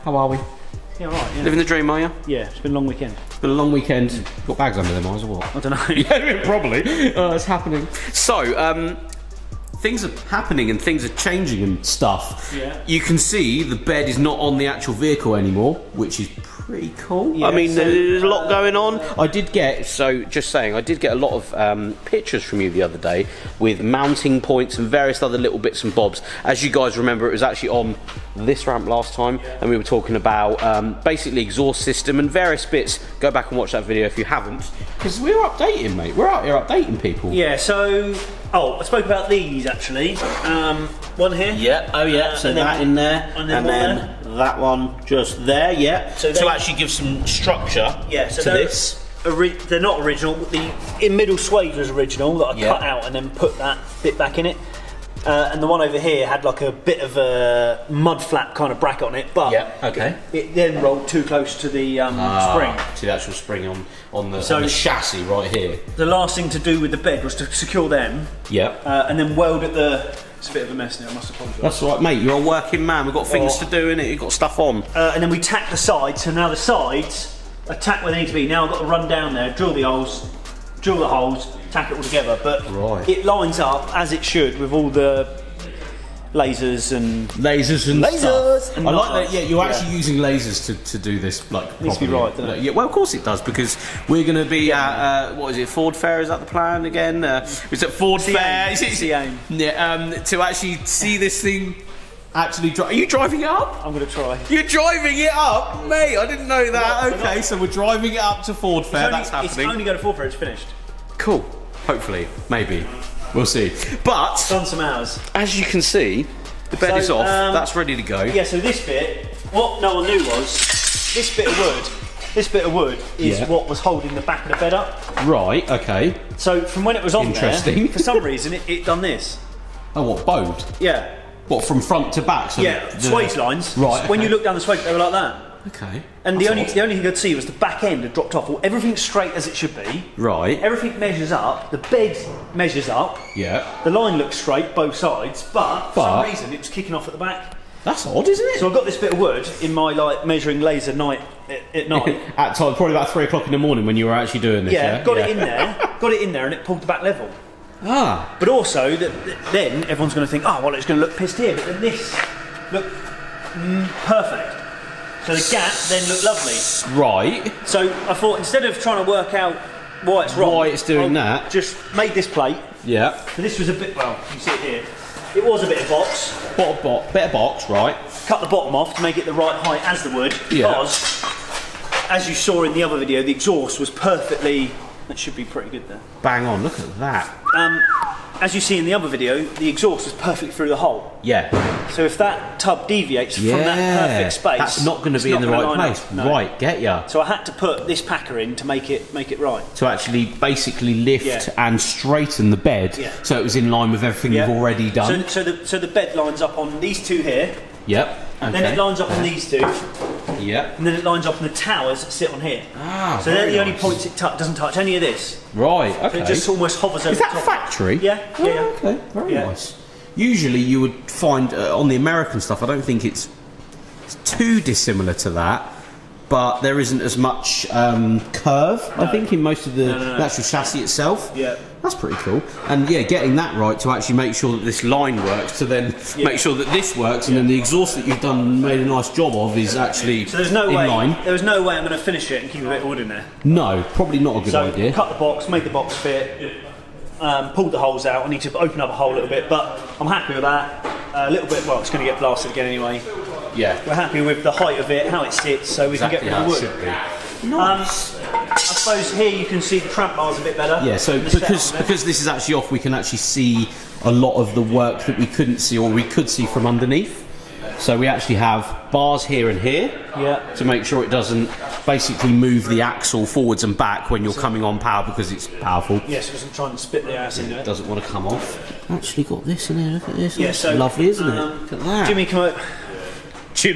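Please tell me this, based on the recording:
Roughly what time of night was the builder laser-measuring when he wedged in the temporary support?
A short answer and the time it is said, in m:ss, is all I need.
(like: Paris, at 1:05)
3 o'clock in the morning, at 2:33.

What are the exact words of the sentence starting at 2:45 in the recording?
So the gap then looked lovely.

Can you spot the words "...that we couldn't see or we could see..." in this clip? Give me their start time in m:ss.
4:25.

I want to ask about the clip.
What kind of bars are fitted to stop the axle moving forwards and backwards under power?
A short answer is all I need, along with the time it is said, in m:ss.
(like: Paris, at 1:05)
tramp bars, at 4:19.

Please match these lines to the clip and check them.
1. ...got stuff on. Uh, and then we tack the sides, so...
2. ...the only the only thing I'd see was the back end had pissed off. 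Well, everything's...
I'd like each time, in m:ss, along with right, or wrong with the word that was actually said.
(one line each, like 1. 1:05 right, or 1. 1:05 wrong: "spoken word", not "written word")
1. 1:14 right
2. 2:16 wrong: "dropped", not "pissed".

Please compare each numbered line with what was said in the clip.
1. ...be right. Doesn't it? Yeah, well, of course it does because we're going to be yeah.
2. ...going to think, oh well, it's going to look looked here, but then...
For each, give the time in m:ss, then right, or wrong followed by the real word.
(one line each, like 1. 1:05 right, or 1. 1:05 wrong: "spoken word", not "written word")
1. 1:32 right
2. 2:40 wrong: "pissed", not "looked".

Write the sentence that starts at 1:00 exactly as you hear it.
it, it then rolled too close to the um, ah, spring.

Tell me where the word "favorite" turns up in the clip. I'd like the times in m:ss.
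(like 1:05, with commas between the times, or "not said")
not said.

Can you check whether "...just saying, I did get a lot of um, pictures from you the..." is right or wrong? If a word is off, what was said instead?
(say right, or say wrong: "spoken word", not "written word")
right.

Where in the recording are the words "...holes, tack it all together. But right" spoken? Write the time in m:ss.
1:21.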